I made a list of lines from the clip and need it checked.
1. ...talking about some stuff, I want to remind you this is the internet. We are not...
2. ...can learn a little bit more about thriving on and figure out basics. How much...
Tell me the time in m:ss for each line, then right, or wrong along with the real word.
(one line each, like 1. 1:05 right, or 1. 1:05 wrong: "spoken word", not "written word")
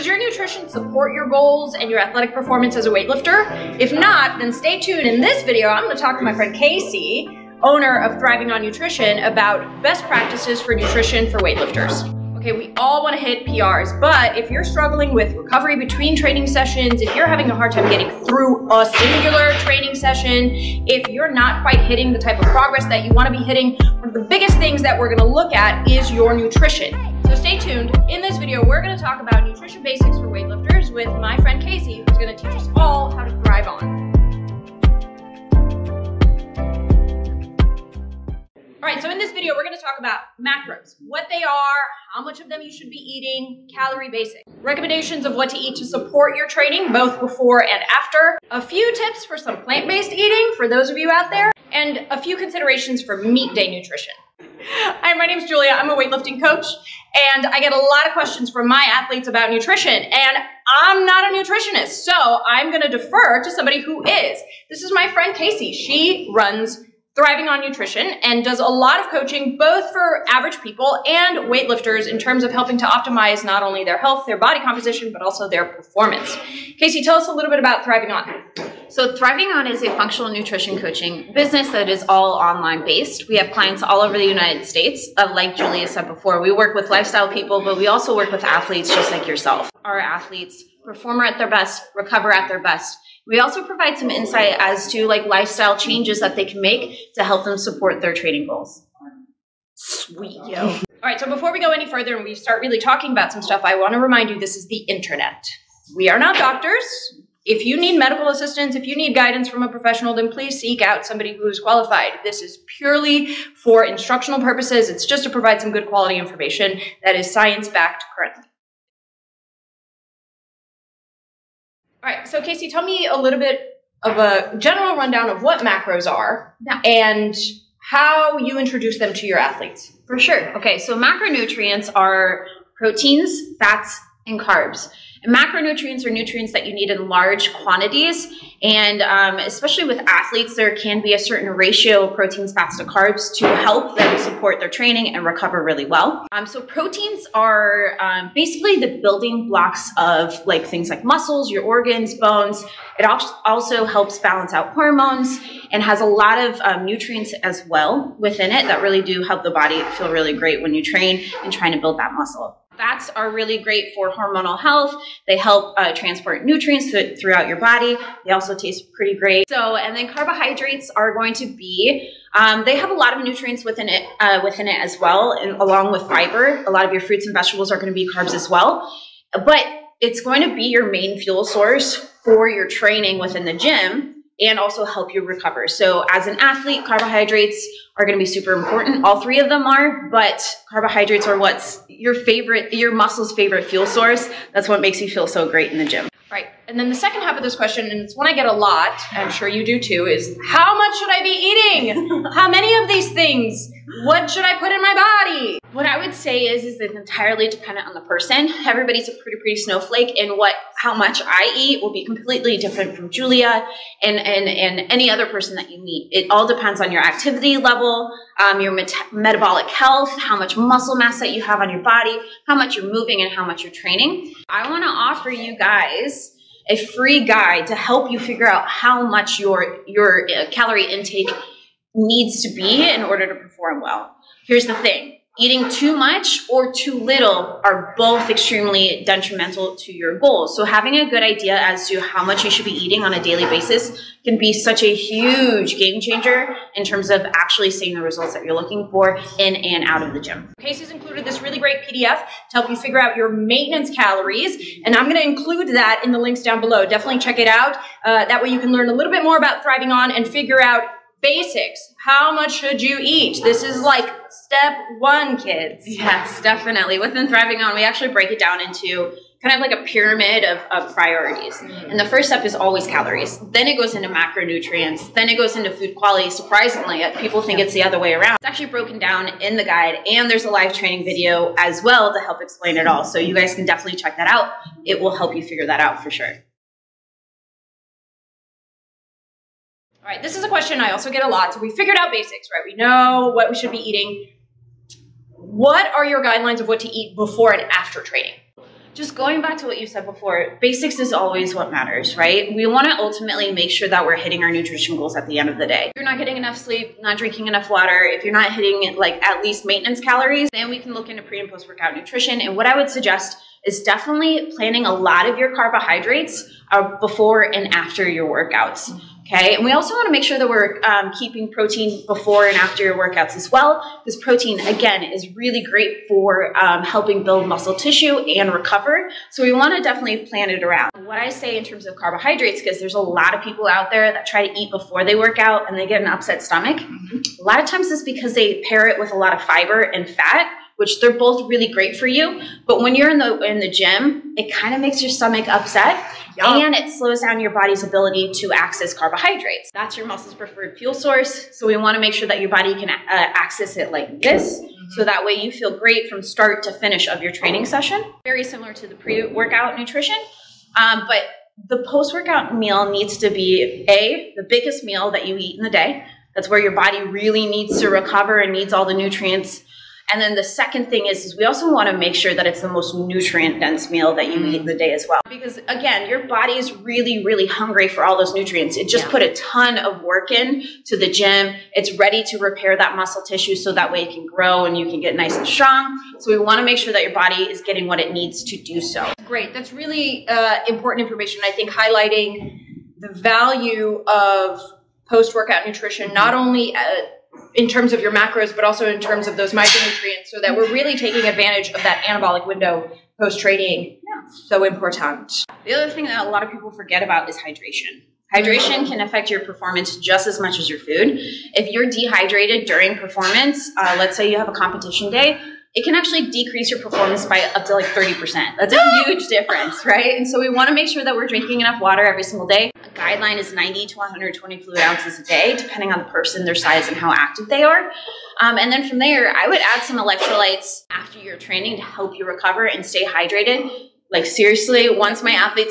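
1. 1:42 right
2. 4:18 right.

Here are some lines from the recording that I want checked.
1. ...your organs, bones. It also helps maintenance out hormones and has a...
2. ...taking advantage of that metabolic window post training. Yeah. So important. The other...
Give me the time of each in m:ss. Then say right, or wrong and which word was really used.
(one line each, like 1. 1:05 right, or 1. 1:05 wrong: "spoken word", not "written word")
1. 2:31 wrong: "balance", not "maintenance"
2. 6:40 wrong: "anabolic", not "metabolic".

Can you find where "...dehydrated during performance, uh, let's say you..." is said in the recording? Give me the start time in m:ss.
6:51.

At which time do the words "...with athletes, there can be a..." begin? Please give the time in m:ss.
2:19.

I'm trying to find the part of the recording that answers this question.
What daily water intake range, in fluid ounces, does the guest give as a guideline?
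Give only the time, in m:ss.
7:03.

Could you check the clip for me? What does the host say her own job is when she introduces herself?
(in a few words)
weightlifting coach.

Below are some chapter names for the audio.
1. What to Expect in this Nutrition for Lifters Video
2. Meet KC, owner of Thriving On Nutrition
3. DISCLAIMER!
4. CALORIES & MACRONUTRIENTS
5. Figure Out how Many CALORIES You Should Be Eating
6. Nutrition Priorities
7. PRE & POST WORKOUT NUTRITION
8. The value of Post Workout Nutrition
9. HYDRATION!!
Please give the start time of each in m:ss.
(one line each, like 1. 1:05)
1. 0:39
2. 1:04
3. 1:44
4. 1:59
5. 3:44
6. 4:29
7. 4:45
8. 6:29
9. 6:45.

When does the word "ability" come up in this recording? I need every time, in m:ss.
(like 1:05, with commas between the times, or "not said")
5:47.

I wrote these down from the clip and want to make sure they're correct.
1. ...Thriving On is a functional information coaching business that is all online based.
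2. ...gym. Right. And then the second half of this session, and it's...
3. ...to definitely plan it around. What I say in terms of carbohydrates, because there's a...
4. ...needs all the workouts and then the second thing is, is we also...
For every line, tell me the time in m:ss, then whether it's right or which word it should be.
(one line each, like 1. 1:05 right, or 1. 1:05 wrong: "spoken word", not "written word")
1. 1:19 wrong: "nutrition", not "information"
2. 3:15 wrong: "question", not "session"
3. 5:29 right
4. 6:08 wrong: "nutrients", not "workouts".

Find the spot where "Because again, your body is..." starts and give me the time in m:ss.
6:15.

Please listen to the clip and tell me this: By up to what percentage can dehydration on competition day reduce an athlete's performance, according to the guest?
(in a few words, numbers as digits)
30%.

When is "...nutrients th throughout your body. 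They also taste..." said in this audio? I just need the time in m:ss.
2:46.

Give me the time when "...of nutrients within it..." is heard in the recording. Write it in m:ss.
2:53.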